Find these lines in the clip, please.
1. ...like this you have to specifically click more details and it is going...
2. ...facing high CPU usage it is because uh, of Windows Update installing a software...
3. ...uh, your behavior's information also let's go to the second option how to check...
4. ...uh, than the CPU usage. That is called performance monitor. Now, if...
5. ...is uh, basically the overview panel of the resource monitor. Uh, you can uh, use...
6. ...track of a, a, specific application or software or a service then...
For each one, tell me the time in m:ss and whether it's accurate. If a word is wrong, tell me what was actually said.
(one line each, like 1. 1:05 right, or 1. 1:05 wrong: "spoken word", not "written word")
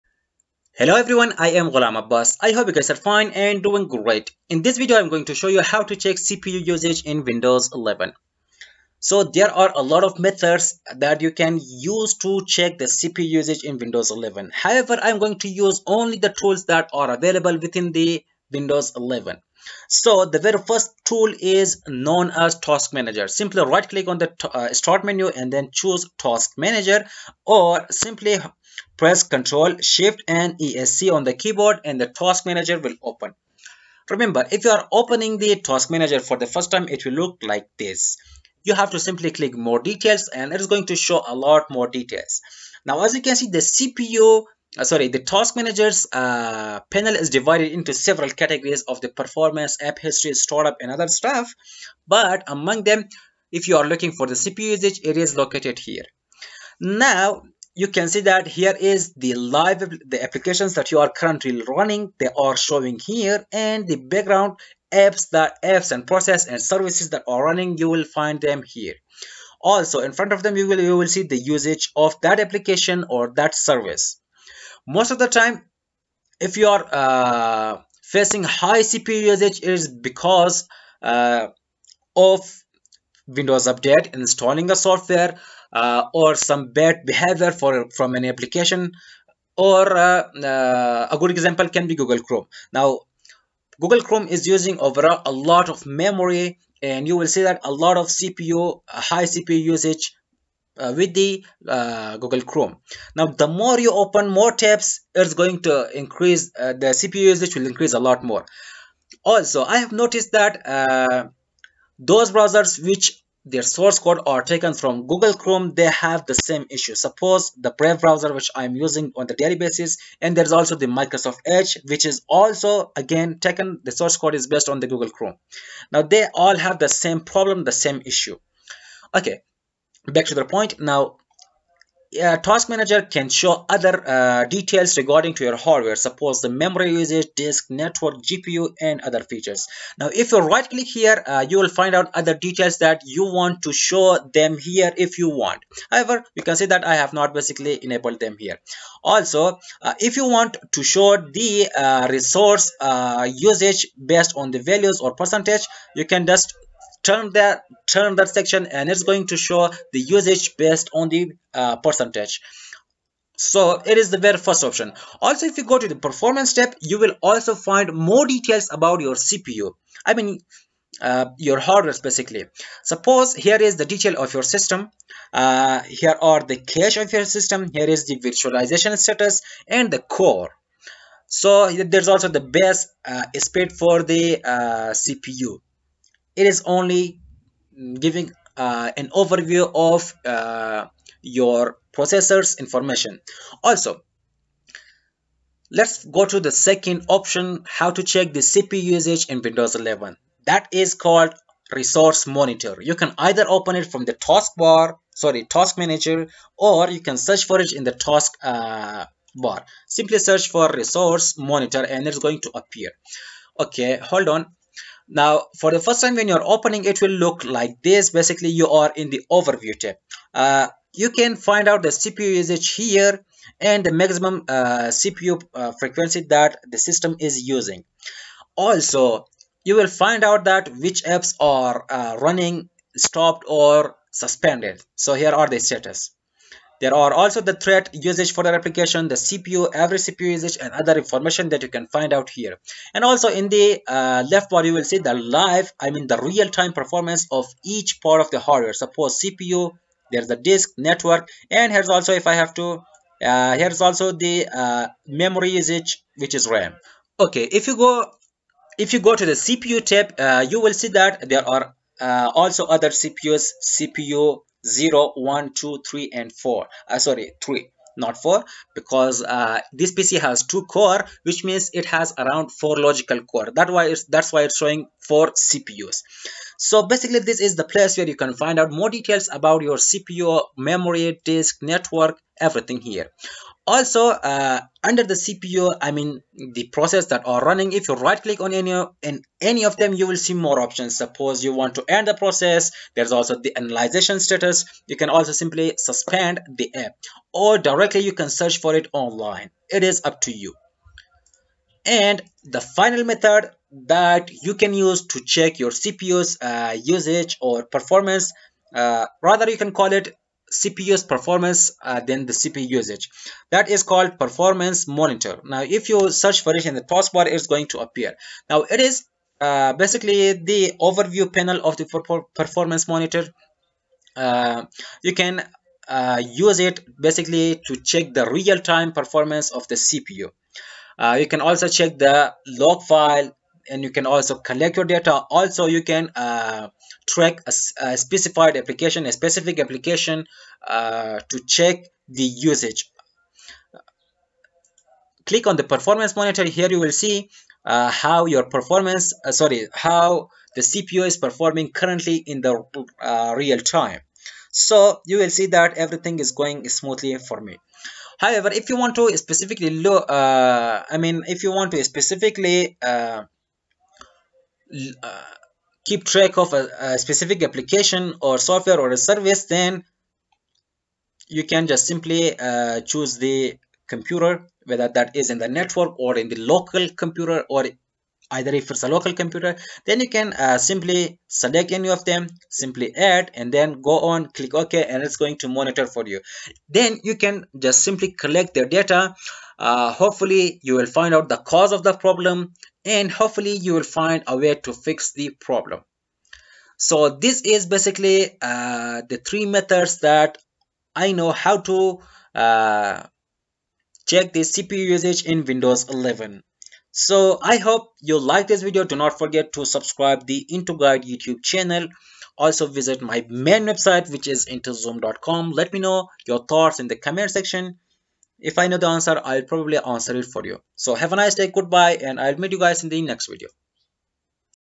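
1. 0:37 wrong: "simply", not "specifically"
2. 1:18 right
3. 3:10 wrong: "processor", not "behavior"
4. 5:11 right
5. 5:18 wrong: "performance", not "resource"
6. 6:06 right.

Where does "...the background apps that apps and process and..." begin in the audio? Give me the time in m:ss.
1:03.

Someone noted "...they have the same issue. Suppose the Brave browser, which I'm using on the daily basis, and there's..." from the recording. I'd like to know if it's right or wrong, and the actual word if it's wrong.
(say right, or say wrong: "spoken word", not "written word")
right.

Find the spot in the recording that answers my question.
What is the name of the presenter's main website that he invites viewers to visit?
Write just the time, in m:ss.
6:54.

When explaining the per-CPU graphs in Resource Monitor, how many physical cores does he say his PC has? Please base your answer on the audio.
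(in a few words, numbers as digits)
2.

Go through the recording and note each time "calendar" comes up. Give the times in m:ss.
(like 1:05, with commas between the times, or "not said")
not said.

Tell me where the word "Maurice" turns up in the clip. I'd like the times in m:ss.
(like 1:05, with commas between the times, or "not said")
not said.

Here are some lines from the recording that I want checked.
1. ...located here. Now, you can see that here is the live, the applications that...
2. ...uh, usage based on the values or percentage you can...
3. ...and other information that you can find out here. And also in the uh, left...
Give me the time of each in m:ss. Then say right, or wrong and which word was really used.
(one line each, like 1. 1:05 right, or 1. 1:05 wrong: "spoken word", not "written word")
1. 0:55 right
2. 2:32 right
3. 4:00 right.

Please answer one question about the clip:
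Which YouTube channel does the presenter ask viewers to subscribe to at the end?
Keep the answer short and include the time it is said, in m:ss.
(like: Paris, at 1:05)
Into Guide, at 6:50.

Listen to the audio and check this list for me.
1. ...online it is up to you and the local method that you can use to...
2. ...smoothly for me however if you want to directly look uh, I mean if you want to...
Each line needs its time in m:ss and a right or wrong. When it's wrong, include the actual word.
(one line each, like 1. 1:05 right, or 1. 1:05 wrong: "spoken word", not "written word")
1. 4:58 wrong: "final", not "local"
2. 5:56 wrong: "specifically", not "directly".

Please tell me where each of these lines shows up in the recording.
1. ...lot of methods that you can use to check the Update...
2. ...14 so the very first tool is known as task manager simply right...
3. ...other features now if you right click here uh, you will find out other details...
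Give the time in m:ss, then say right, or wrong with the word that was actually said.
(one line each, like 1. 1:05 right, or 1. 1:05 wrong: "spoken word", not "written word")
1. 0:09 wrong: "CPU", not "Update"
2. 0:18 wrong: "11", not "14"
3. 2:19 right.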